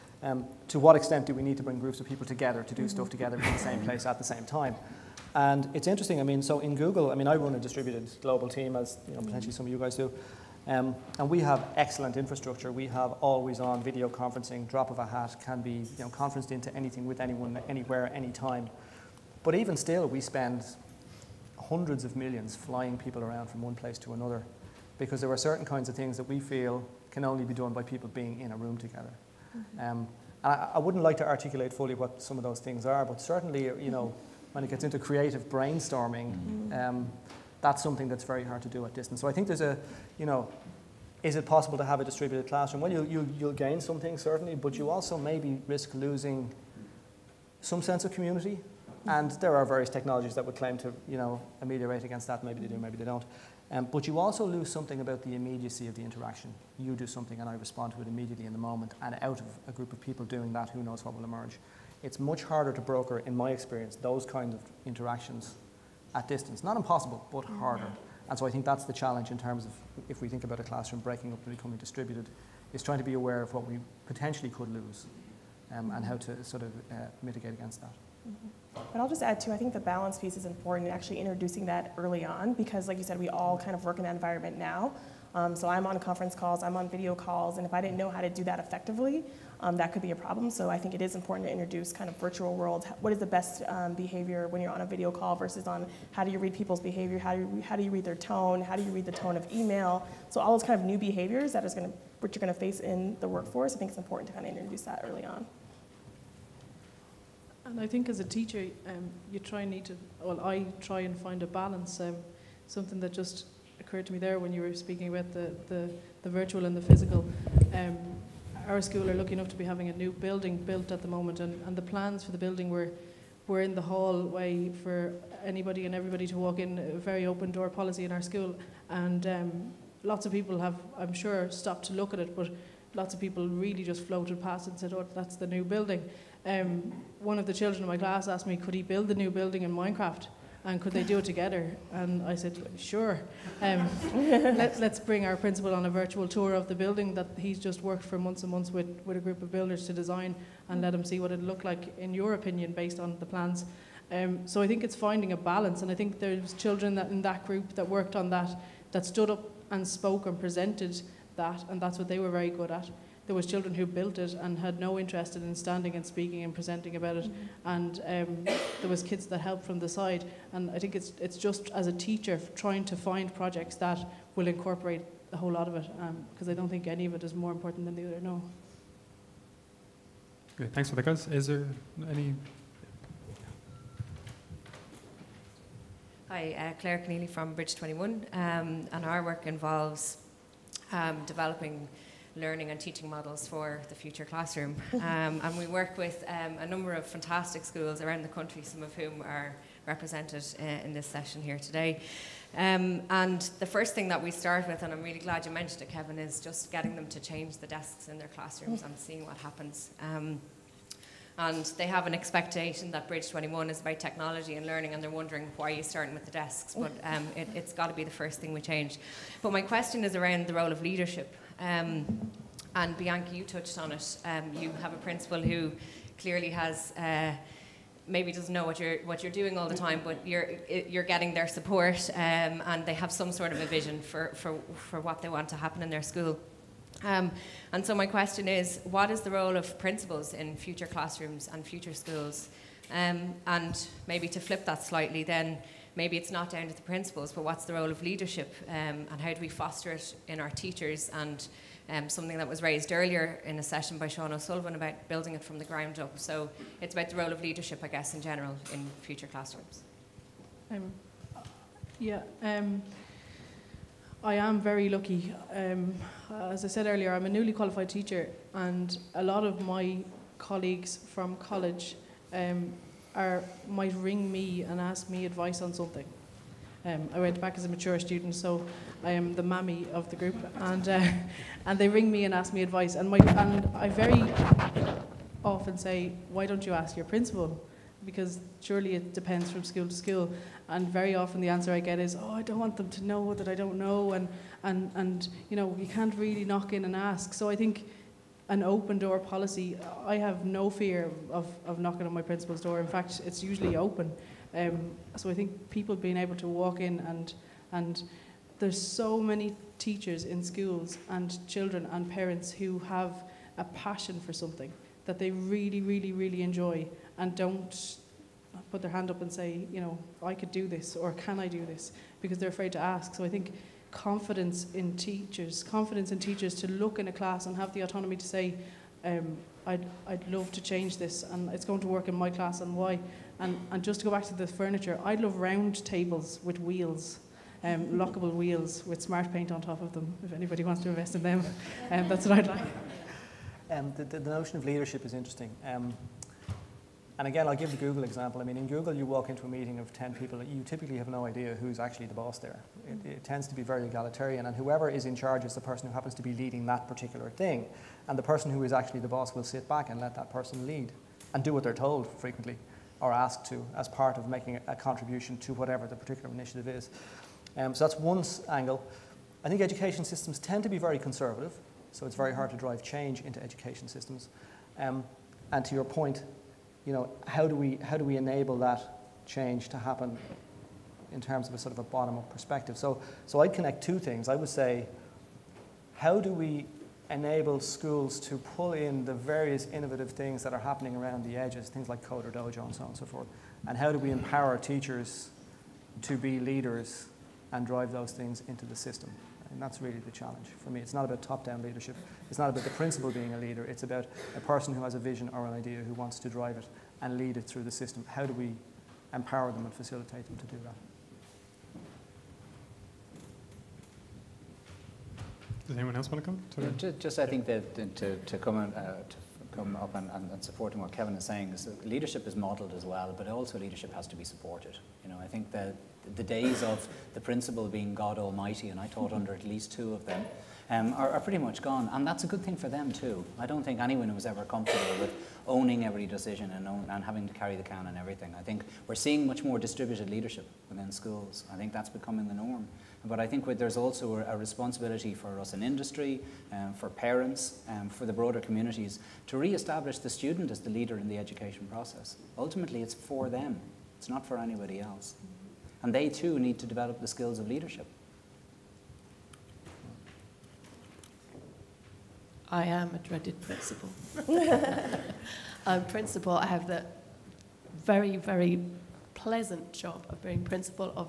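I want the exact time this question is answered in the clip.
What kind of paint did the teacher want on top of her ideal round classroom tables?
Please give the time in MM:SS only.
05:39.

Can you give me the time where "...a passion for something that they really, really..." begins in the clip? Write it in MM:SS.
05:13.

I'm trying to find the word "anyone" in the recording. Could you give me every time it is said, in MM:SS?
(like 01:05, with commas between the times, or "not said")
00:17, 06:55, 07:13.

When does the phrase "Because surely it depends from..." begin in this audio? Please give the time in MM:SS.
04:48.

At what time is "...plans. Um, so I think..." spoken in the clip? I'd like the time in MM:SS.
02:33.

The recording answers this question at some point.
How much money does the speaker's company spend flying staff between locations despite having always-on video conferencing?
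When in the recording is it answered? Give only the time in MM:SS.
00:21.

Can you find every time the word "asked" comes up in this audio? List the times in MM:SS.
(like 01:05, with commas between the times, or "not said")
02:18, 06:03.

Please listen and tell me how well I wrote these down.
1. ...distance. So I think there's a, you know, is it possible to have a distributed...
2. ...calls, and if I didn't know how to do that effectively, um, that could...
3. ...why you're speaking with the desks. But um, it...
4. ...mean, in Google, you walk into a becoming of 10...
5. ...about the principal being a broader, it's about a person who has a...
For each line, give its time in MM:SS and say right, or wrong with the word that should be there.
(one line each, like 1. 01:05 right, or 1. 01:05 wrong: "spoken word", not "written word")
1. 00:38 right
2. 01:27 right
3. 03:35 wrong: "starting", not "speaking"
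4. 05:48 wrong: "meeting", not "becoming"
5. 06:42 wrong: "leader", not "broader".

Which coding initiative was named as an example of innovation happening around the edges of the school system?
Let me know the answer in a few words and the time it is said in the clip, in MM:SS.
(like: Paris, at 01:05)
CoderDojo, at 06:32.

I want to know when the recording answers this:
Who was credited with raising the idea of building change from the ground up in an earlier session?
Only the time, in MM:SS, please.
04:14.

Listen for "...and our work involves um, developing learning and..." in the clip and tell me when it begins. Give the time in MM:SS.
03:08.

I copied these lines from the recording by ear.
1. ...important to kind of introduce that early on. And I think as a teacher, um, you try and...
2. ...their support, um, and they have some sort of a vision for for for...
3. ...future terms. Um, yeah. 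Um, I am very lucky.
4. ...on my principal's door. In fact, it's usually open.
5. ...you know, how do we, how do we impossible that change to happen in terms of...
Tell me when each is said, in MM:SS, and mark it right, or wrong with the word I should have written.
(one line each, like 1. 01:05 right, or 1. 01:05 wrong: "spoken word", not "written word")
1. 01:43 right
2. 03:51 right
3. 04:19 wrong: "classrooms", not "terms"
4. 05:02 right
5. 06:16 wrong: "enable", not "impossible".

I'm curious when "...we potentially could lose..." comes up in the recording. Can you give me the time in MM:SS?
01:13.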